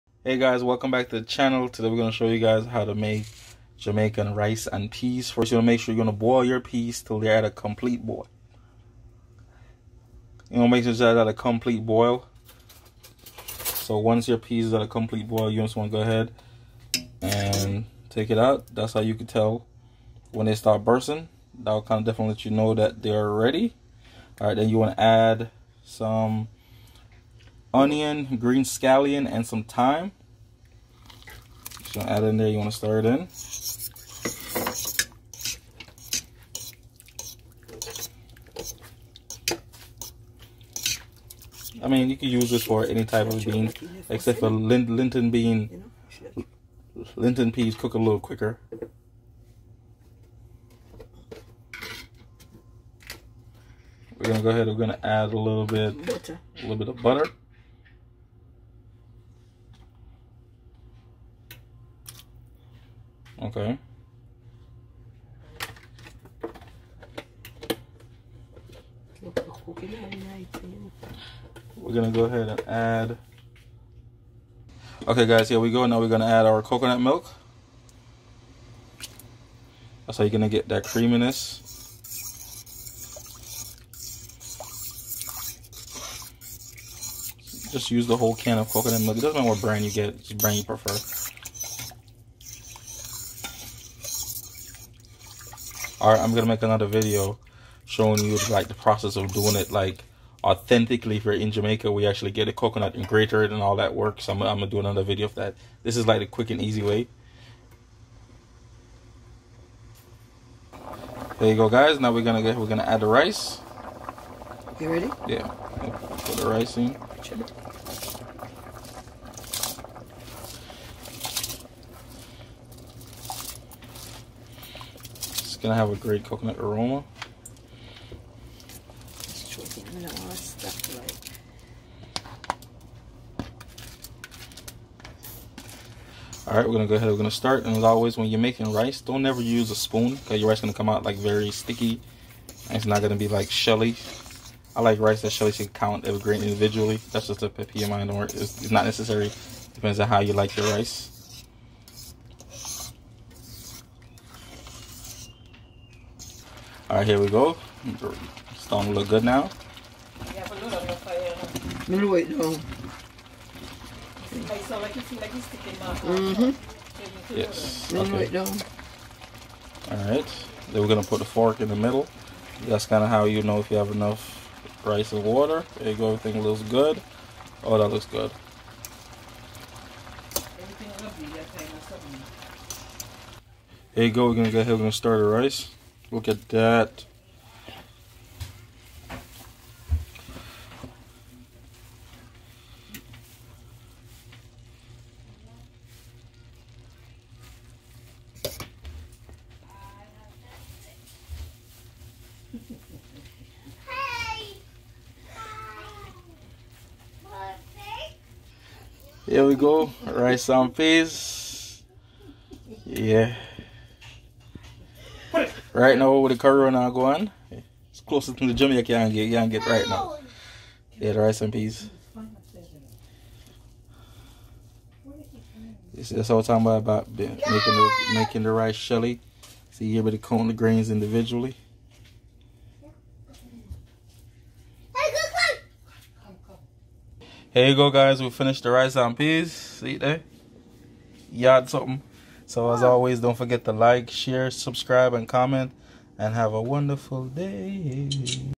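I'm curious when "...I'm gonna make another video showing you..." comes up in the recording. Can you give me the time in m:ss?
1:36.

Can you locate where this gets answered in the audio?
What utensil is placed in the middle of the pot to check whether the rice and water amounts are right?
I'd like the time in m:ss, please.
2:51.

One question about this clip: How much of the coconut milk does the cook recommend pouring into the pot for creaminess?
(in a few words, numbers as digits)
The whole can.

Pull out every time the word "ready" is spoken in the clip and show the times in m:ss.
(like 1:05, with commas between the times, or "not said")
0:23, 1:54.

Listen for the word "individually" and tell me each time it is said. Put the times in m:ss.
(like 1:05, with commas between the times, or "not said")
2:26, 3:50.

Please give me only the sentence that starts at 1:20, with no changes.
That's how you're gonna get that creaminess.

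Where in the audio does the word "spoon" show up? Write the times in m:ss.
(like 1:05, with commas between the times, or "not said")
2:19.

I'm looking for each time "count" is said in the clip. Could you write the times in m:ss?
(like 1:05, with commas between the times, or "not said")
2:25, 3:50.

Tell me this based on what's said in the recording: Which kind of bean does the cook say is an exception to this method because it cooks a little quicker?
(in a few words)
Linton bean.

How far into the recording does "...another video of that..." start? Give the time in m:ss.
1:44.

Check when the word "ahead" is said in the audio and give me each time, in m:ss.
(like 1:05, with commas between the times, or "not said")
0:16, 0:54, 1:12, 2:16, 3:04.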